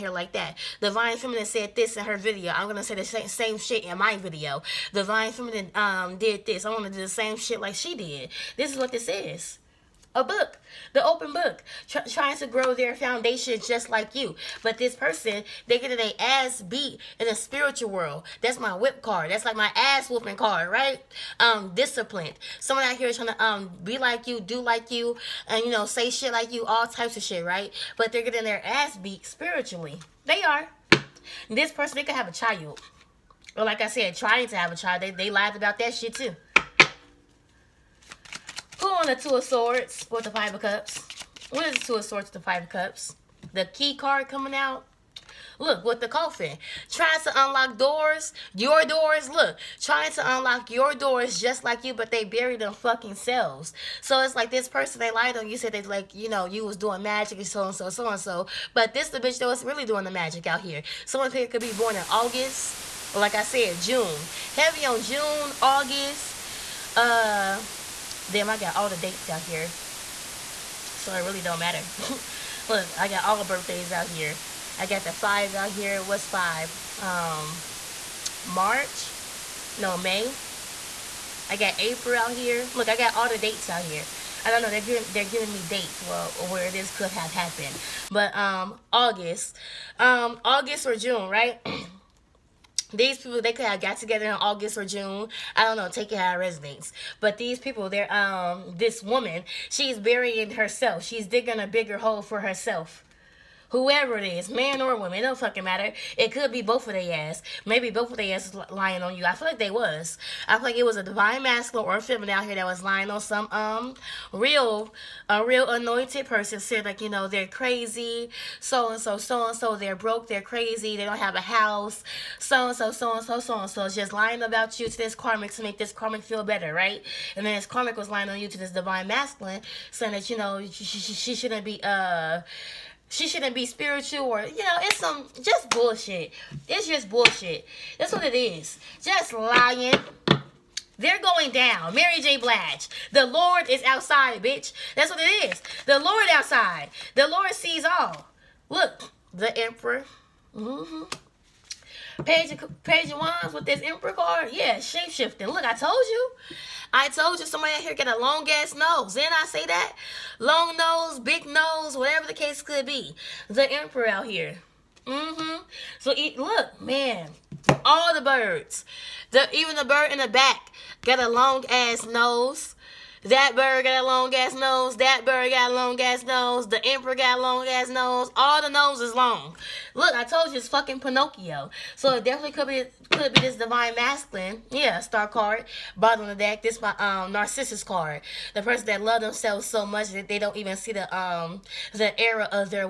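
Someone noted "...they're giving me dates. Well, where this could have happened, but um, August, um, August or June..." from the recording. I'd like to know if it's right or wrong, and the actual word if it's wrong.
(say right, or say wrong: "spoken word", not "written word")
right.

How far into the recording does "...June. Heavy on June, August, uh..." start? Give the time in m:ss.
1:03.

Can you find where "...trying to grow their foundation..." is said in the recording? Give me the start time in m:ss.
0:12.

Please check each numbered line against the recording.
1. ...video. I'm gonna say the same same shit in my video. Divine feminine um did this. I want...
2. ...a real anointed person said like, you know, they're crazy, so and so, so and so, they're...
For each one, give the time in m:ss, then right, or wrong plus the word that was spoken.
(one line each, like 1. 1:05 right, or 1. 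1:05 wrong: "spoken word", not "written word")
1. 0:02 right
2. 1:55 right.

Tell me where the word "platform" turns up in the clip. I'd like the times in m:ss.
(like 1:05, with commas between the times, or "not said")
not said.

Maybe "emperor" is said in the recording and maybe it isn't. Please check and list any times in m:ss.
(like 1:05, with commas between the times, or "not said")
2:29, 2:33, 2:43, 2:56.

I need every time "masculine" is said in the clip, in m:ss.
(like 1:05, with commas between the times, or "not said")
1:51, 2:09, 3:03.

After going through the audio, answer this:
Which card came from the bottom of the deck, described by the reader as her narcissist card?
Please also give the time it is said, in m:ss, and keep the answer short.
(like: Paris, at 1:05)
Star card, at 3:04.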